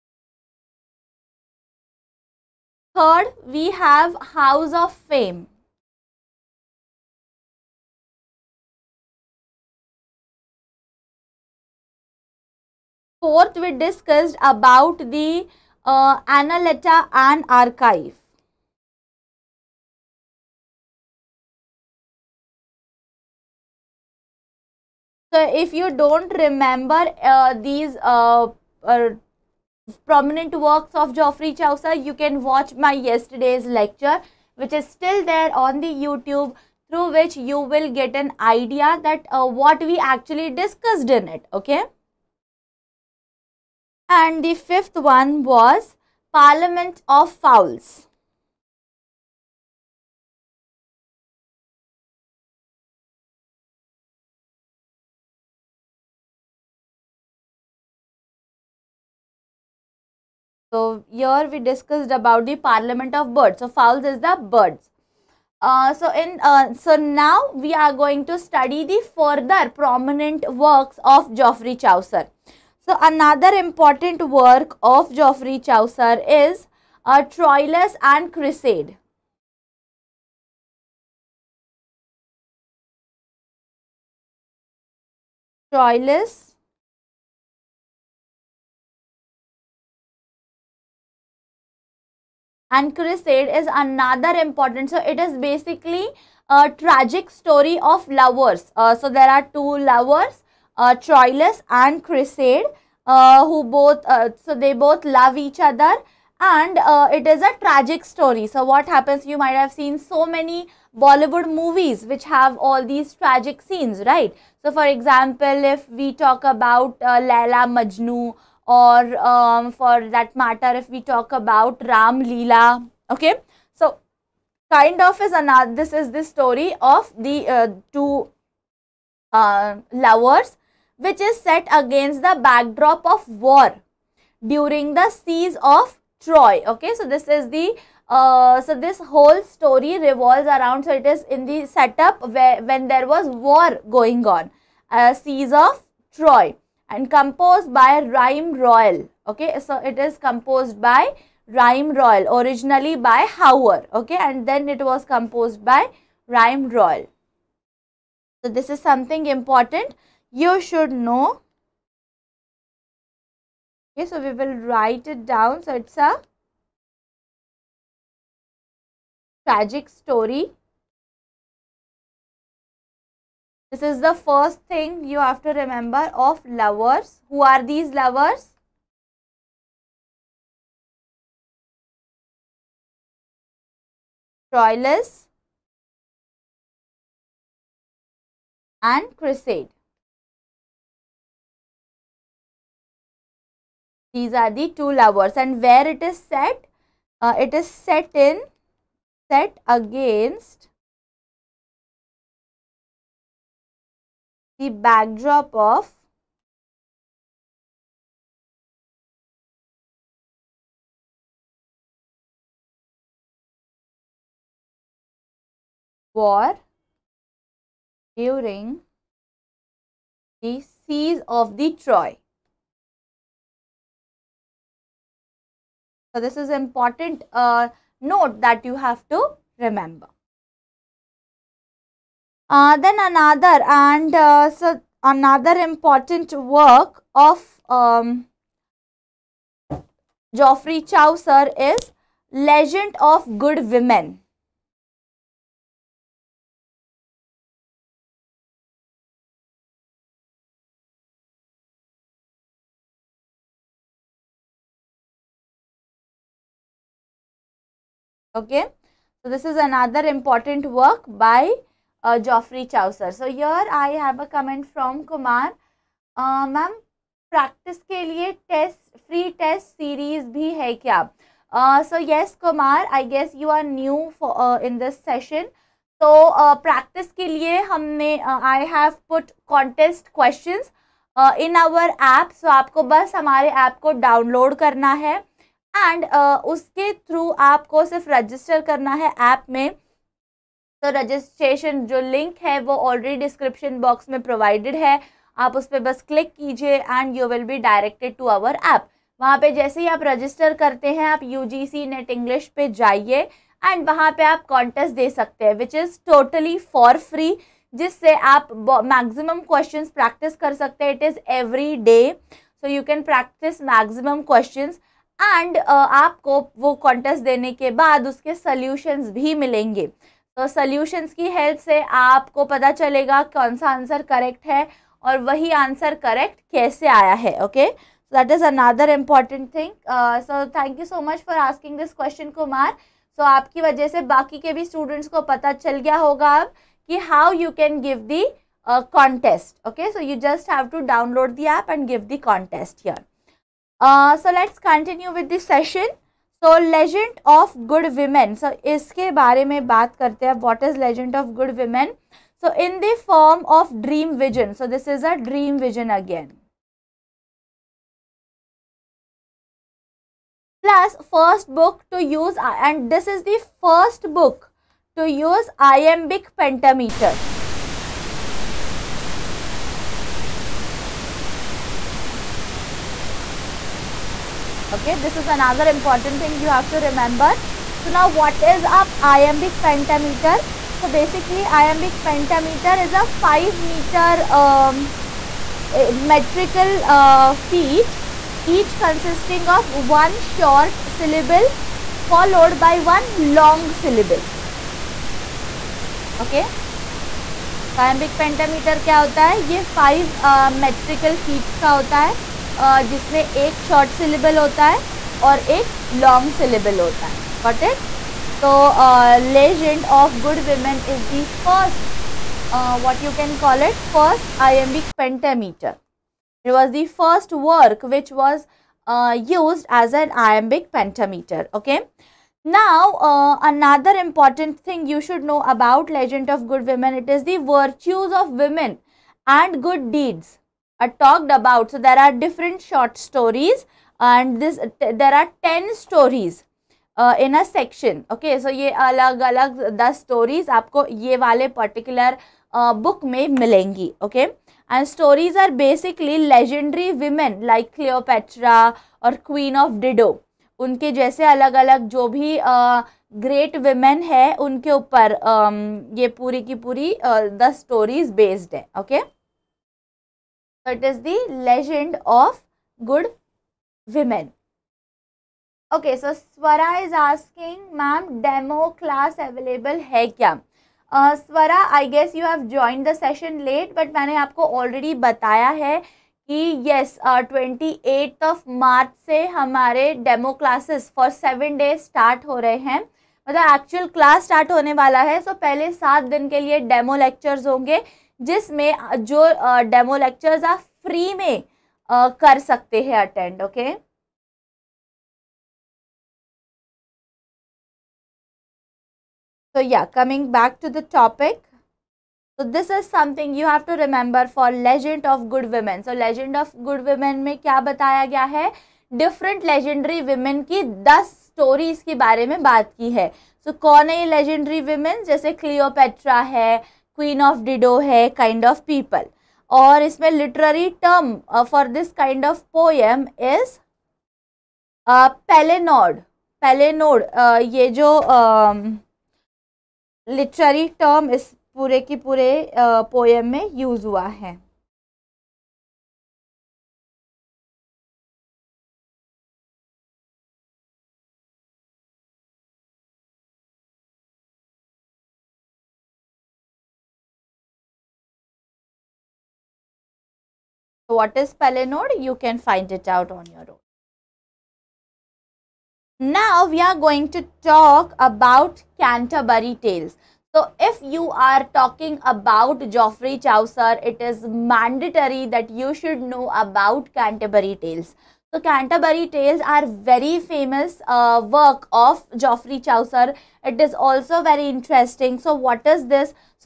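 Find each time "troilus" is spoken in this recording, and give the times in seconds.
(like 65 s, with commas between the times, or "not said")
77 s, 85 s, 101 s, 184 s.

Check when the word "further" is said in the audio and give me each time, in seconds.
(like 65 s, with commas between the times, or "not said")
69 s.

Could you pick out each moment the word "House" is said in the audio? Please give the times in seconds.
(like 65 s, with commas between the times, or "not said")
4 s.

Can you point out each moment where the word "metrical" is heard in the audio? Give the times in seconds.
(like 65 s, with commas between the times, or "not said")
386 s, 400 s.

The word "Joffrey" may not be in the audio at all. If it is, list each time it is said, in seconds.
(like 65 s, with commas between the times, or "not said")
262 s.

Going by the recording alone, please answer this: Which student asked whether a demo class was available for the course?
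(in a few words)
Swara.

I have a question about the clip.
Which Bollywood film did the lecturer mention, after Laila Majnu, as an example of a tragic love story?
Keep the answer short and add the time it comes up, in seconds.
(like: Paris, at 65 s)
Ram Leela, at 121 s.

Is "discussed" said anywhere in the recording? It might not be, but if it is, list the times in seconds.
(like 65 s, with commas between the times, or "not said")
13 s, 40 s, 61 s.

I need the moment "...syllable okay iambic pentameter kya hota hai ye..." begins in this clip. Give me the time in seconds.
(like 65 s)
393 s.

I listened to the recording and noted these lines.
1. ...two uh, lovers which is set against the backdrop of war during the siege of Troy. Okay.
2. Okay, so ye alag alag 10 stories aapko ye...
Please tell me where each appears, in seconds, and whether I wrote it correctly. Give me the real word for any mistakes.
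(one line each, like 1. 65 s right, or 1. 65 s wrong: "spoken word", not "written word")
1. 127 s right
2. 438 s right.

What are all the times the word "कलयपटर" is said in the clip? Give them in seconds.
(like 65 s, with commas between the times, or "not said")
515 s.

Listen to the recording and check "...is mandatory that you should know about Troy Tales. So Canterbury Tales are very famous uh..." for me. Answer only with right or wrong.
wrong.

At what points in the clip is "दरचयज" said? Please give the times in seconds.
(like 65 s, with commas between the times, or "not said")
427 s.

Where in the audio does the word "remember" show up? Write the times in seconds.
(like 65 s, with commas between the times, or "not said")
26 s, 175 s, 229 s, 376 s.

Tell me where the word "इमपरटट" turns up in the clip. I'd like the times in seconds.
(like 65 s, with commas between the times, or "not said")
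328 s, 423 s.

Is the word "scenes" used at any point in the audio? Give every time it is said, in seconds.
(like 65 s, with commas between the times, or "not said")
113 s.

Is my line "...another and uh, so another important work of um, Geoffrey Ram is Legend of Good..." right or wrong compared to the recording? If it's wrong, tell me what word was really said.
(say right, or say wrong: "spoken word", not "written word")
wrong: "Chaucer", not "Ram".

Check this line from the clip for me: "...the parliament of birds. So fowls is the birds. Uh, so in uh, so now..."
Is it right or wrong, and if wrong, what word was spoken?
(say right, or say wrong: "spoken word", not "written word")
right.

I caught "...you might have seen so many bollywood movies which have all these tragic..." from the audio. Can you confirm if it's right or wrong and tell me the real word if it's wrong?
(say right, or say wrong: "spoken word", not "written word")
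right.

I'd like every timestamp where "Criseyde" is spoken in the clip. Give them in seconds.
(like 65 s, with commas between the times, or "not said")
78 s, 92 s, 102 s, 189 s.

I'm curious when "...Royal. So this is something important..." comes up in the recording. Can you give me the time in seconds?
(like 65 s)
156 s.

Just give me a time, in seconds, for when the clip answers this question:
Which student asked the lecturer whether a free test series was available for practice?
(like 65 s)
265 s.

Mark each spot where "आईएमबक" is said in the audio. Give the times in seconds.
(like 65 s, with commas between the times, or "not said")
414 s, 420 s.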